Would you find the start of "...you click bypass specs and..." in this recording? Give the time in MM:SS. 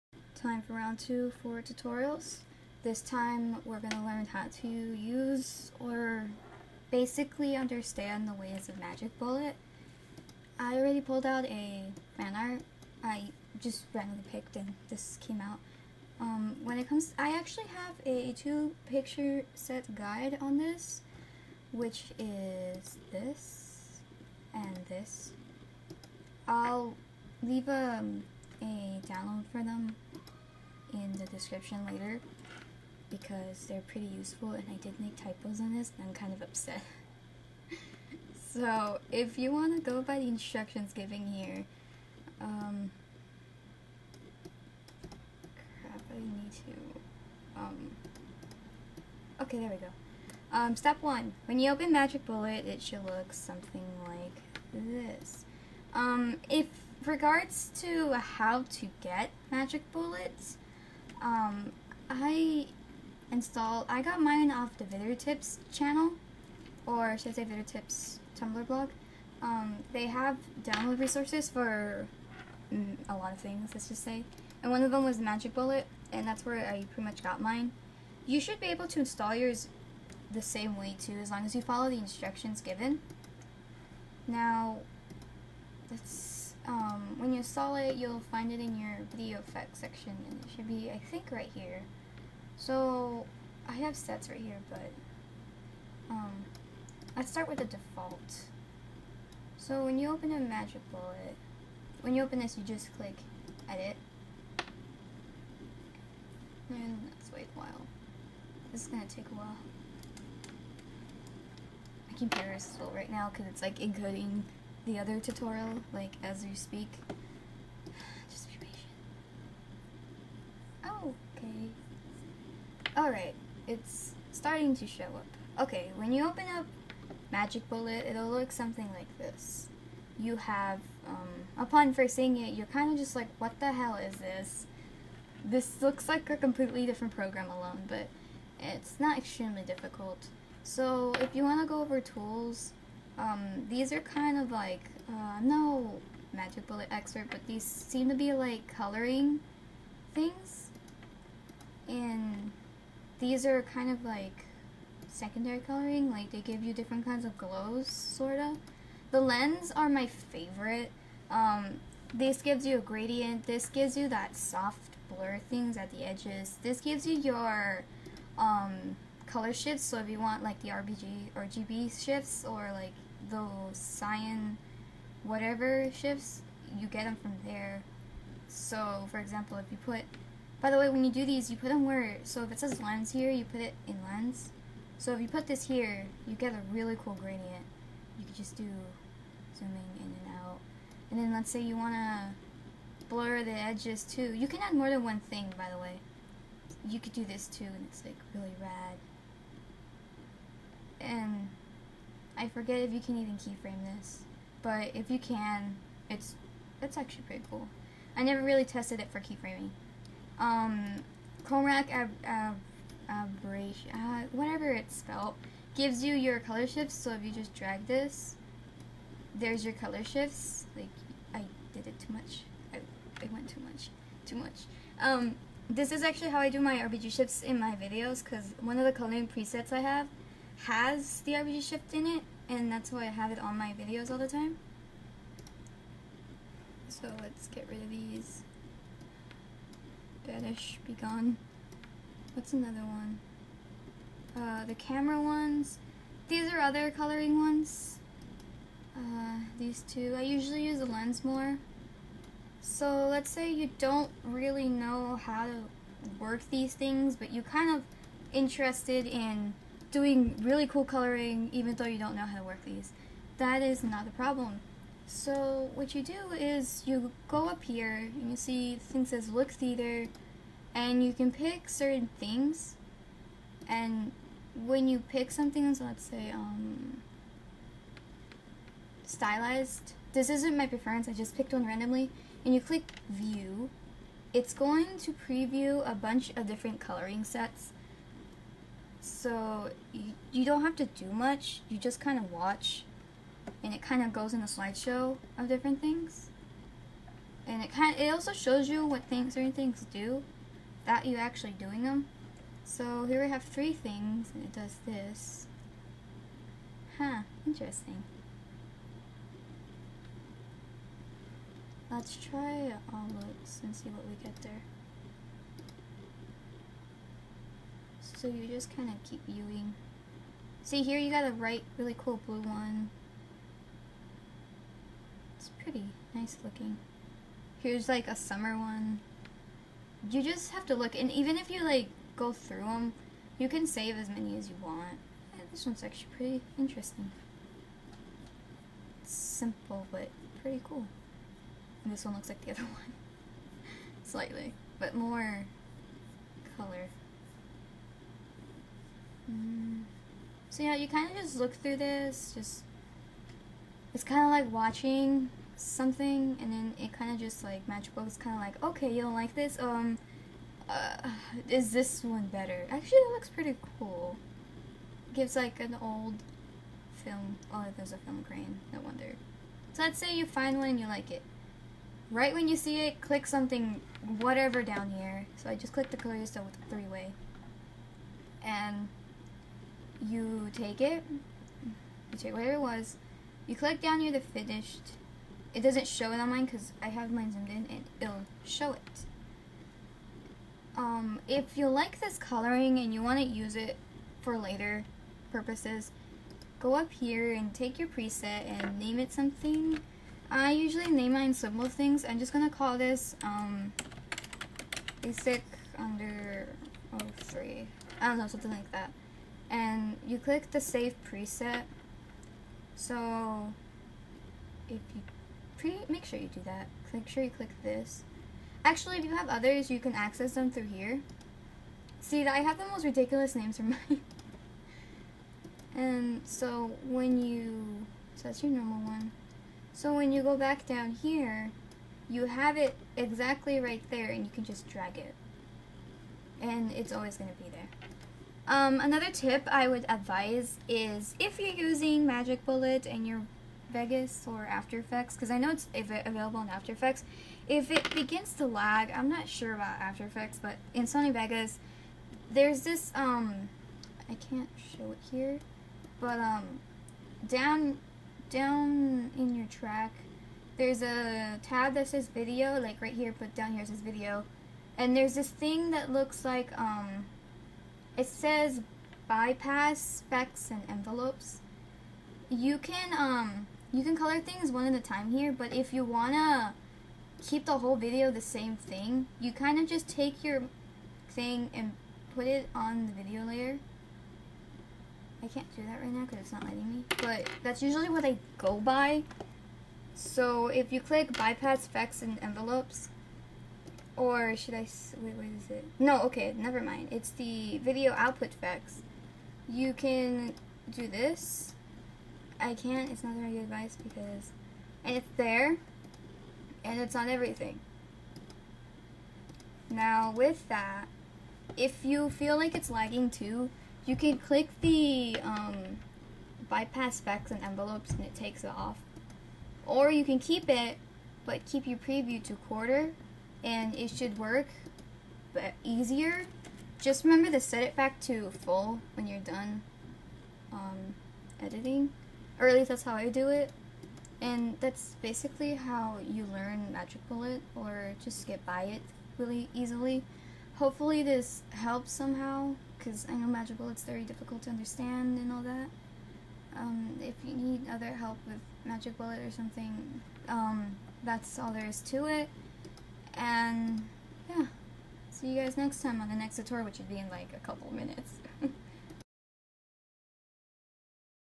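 08:10.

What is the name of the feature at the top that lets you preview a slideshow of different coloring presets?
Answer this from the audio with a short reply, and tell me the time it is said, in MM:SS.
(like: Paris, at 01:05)
Look theater, at 04:29.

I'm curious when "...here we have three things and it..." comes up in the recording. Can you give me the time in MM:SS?
05:03.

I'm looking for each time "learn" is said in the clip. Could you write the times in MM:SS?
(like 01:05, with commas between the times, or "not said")
00:04, 08:56.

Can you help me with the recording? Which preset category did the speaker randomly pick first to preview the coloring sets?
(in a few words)
Stylized.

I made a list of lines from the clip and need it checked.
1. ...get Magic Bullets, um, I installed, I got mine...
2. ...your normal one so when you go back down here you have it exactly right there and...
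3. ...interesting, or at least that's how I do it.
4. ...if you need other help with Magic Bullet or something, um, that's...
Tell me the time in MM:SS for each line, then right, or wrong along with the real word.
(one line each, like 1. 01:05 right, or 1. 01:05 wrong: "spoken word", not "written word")
1. 00:59 right
2. 07:08 right
3. 08:51 wrong: "editing", not "interesting"
4. 09:07 right.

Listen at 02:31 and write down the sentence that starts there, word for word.
And these are kind of like secondary coloring, like they give you different kinds of glows, sorta.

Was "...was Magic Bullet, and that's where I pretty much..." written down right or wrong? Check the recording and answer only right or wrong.
right.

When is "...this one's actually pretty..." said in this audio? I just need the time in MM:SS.
05:35.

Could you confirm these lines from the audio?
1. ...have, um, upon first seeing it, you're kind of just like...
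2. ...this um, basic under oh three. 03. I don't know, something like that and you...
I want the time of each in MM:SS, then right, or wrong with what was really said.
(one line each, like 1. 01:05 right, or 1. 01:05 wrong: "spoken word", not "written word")
1. 02:10 right
2. 06:42 right.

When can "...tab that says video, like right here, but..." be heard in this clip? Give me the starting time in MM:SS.
07:41.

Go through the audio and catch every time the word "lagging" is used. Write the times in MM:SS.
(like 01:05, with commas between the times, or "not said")
08:32.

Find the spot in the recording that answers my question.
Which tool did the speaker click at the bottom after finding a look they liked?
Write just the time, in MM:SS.
06:15.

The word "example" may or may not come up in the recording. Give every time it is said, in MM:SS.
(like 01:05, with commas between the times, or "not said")
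02:59.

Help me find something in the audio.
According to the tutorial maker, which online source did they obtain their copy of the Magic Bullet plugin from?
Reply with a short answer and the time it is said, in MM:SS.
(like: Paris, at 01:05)
Vidder Tips Tumblr blog, at 01:07.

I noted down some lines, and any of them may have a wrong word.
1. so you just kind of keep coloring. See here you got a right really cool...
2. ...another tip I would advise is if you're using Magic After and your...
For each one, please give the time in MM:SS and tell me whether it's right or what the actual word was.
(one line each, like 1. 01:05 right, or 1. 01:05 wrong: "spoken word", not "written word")
1. 05:18 wrong: "viewing", not "coloring"
2. 07:18 wrong: "Bullet", not "After".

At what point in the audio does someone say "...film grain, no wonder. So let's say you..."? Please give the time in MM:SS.
06:07.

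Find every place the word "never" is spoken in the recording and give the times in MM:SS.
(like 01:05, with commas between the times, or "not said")
03:28, 08:16.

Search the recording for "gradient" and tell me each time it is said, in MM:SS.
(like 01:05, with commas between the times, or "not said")
02:42, 03:07.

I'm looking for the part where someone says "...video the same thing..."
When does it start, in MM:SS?
07:57.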